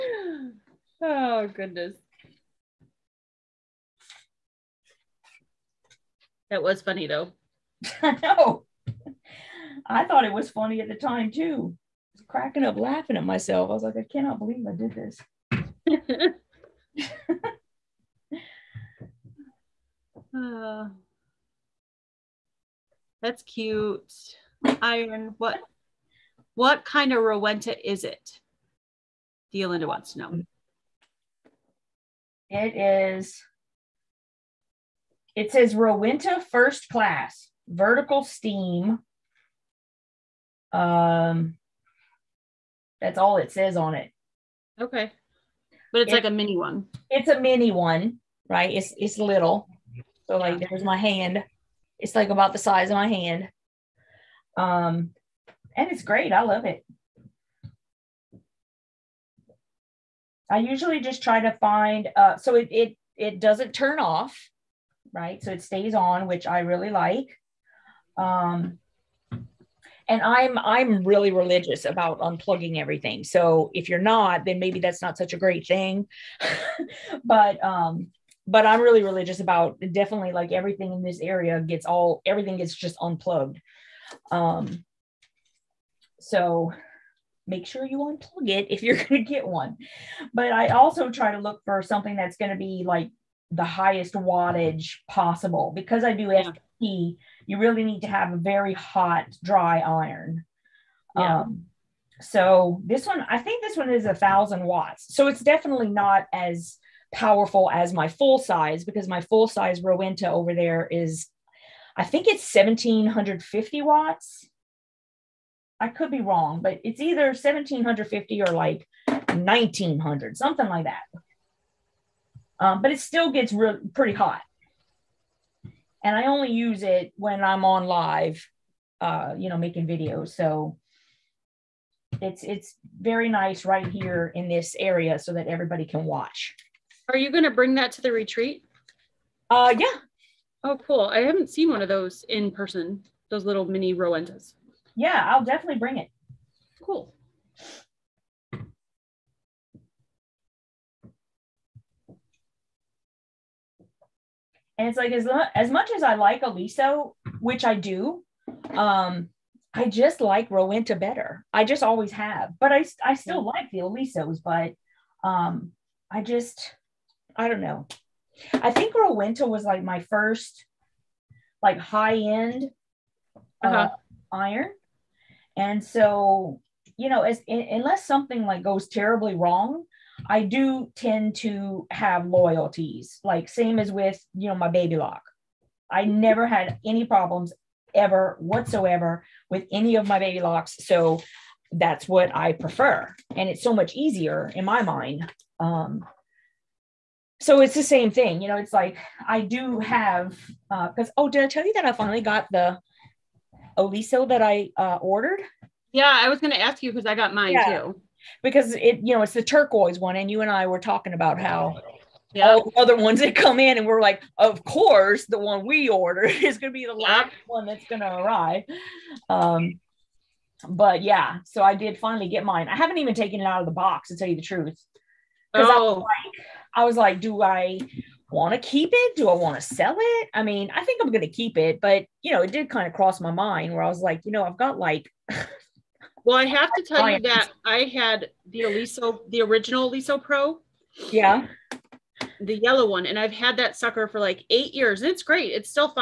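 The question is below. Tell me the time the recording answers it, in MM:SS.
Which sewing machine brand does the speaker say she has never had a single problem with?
03:04.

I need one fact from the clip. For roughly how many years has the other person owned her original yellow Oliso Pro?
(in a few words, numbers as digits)
8 years.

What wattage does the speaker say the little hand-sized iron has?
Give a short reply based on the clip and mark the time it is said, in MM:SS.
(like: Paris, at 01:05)
1000 watts, at 01:44.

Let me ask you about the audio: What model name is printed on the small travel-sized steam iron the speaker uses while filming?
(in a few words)
First Class.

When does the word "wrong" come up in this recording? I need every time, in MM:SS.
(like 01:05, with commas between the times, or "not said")
01:56, 02:59.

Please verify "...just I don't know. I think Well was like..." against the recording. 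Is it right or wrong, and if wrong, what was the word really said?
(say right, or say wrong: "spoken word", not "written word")
wrong: "Rowenta", not "Well".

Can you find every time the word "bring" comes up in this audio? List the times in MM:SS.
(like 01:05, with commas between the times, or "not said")
02:17, 02:25.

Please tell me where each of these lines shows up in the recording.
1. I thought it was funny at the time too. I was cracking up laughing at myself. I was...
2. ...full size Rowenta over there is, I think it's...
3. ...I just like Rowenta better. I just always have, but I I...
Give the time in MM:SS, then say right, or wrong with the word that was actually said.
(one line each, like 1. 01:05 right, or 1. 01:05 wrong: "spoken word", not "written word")
1. 00:09 right
2. 01:49 right
3. 02:39 right.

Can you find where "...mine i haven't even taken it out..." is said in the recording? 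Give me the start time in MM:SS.
03:42.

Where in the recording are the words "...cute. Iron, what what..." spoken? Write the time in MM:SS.
00:23.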